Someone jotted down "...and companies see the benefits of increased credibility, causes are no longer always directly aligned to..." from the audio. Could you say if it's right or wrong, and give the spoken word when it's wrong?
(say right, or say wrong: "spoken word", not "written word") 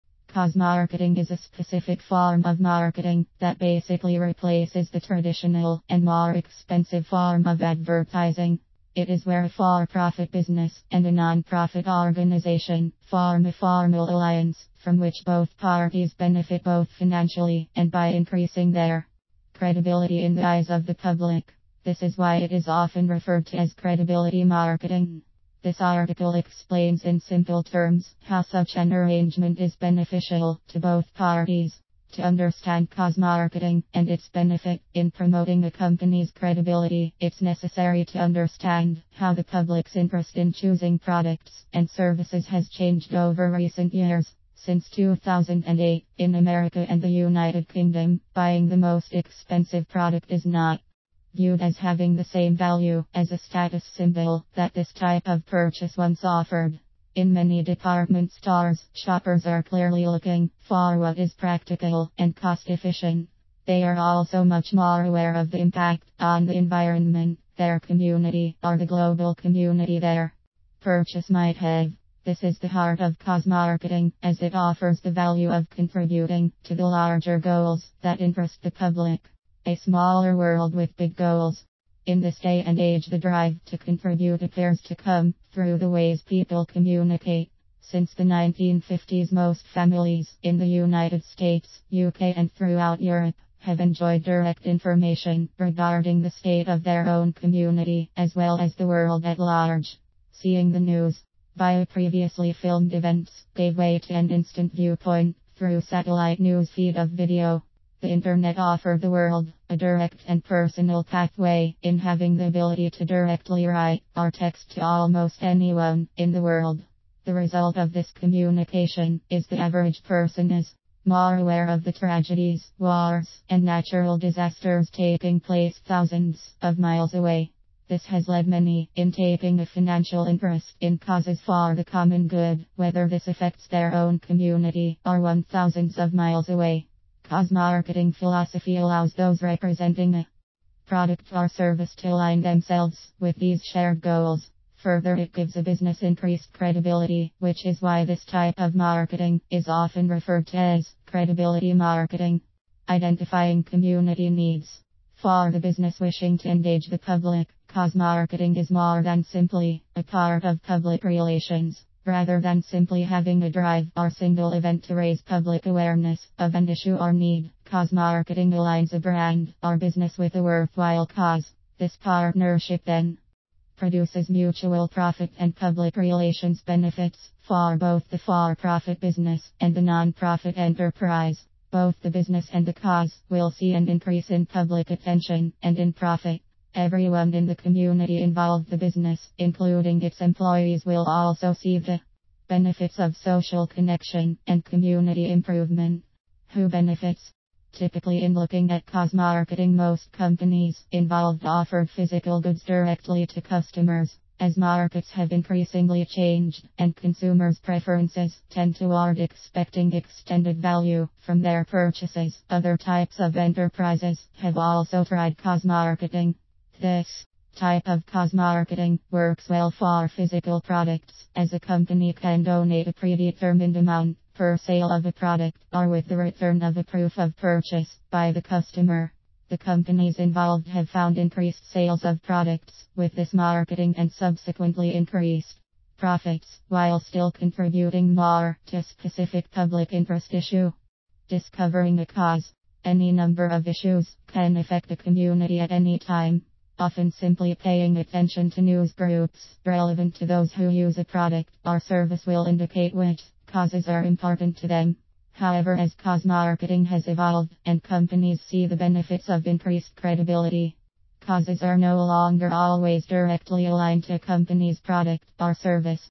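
right.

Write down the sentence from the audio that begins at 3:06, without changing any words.
Everyone in the community involved the business, including its employees, will also see the benefits of social connection and community improvement.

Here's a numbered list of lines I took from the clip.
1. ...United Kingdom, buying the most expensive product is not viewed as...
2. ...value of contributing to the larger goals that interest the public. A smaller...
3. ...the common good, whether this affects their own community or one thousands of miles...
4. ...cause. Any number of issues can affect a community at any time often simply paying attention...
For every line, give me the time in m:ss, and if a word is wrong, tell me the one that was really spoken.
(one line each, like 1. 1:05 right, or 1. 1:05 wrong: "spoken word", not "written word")
1. 0:47 right
2. 1:15 right
3. 2:11 right
4. 4:02 right.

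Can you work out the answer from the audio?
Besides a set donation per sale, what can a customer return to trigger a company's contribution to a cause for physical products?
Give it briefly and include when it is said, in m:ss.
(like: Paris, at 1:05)
proof of purchase, at 3:46.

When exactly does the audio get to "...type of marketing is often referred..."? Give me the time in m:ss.
2:28.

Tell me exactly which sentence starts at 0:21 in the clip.
This is why it is often referred to as credibility marketing.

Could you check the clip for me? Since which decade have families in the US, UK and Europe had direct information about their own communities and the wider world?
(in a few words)
1950s.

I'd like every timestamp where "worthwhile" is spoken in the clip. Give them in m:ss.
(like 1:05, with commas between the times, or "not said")
2:50.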